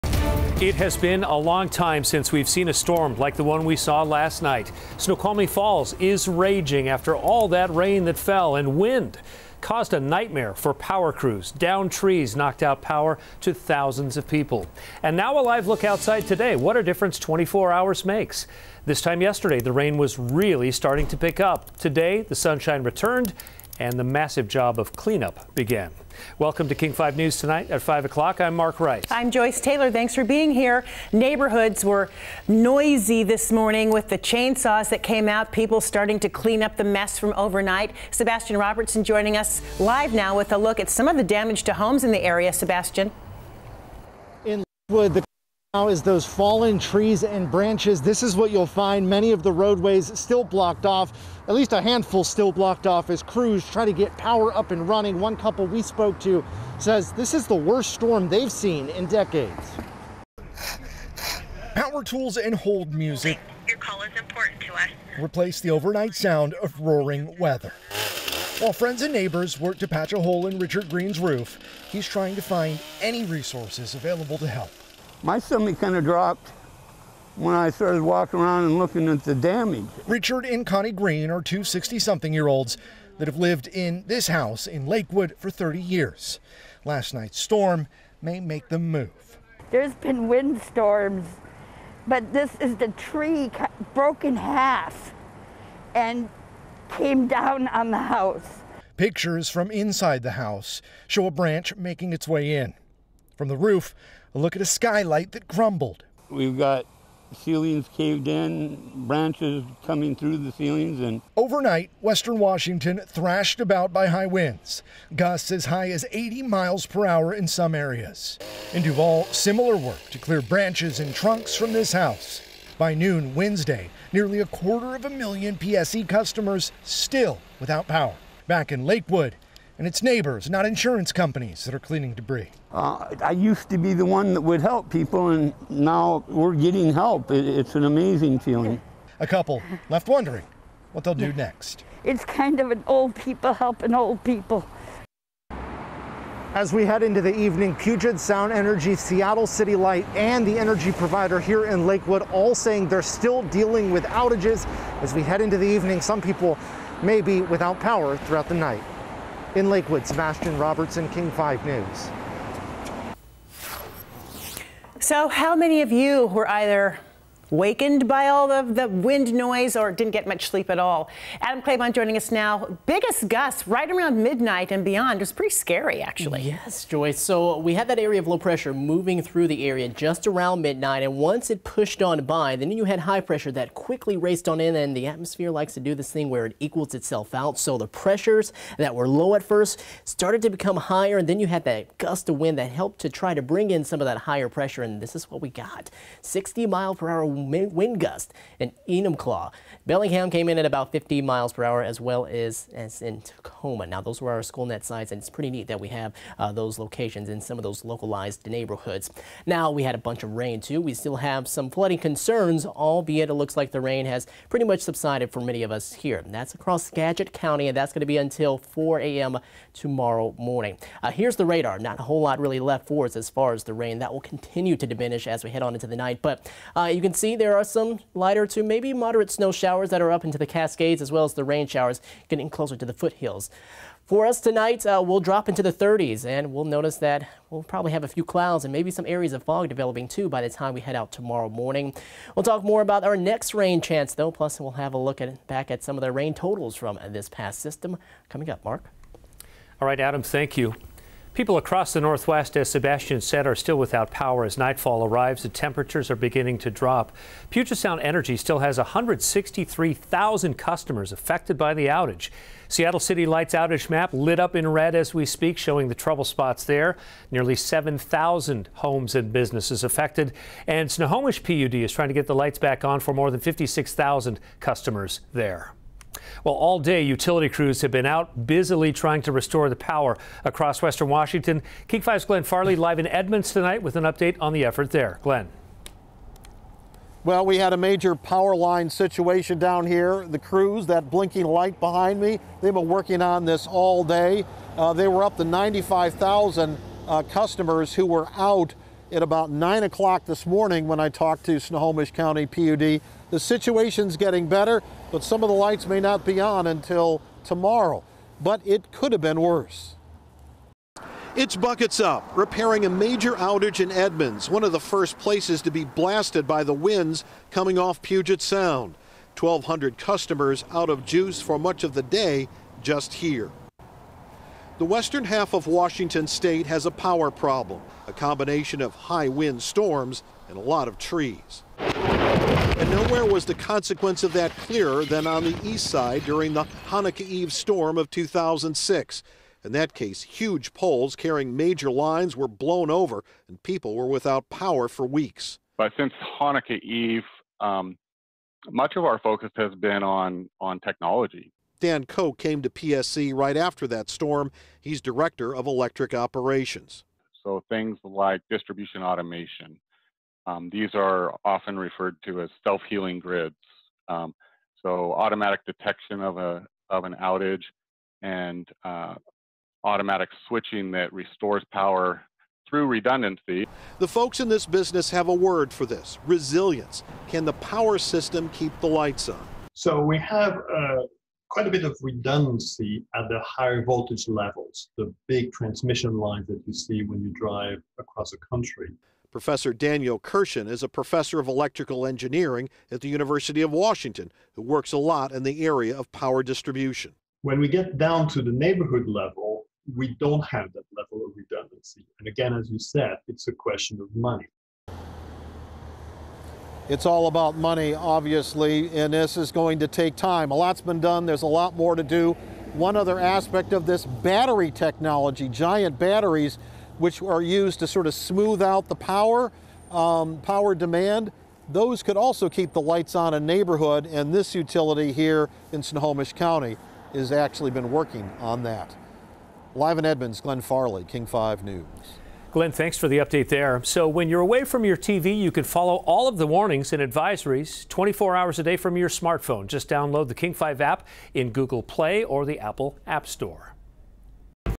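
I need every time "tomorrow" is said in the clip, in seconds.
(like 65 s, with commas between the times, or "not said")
219 s, 241 s, 307 s.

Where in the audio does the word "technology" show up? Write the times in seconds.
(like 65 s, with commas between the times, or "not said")
350 s, 414 s.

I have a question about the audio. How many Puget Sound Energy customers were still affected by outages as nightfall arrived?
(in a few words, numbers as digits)
163,000.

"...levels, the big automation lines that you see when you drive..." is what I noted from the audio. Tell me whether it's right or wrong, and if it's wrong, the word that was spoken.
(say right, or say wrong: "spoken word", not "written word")
wrong: "transmission", not "automation".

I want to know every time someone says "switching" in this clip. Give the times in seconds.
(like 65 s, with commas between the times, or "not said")
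370 s.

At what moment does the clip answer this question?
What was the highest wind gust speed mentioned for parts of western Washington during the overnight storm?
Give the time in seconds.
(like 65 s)
116 s.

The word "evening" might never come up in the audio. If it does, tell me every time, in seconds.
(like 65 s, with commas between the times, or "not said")
147 s, 155 s.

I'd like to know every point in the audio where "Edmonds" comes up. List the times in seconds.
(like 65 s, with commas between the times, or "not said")
283 s, 313 s, 430 s.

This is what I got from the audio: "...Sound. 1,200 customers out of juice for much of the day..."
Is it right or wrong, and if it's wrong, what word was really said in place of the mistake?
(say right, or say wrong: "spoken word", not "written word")
right.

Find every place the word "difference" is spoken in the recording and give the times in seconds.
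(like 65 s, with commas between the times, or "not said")
16 s.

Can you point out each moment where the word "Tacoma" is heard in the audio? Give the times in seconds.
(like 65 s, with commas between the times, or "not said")
203 s.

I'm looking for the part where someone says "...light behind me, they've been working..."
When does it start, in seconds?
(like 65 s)
291 s.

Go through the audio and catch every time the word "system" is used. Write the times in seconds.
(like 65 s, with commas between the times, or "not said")
247 s, 377 s.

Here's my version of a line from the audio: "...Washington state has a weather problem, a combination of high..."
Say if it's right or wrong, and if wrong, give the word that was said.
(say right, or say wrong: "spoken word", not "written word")
wrong: "power", not "weather".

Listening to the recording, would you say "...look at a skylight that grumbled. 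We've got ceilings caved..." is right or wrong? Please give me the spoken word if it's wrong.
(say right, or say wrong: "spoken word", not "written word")
right.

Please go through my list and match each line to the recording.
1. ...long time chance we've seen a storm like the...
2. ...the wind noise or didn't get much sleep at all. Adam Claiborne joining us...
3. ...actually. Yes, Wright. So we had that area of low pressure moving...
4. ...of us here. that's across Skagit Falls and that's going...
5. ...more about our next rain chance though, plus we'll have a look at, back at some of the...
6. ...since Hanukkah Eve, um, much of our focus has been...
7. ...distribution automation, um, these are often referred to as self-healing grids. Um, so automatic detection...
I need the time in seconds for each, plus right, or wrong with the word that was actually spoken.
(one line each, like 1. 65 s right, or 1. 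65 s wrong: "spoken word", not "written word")
1. 1 s wrong: "since", not "chance"
2. 168 s right
3. 176 s wrong: "Joyce", not "Wright"
4. 215 s wrong: "County", not "Falls"
5. 242 s right
6. 345 s right
7. 358 s right.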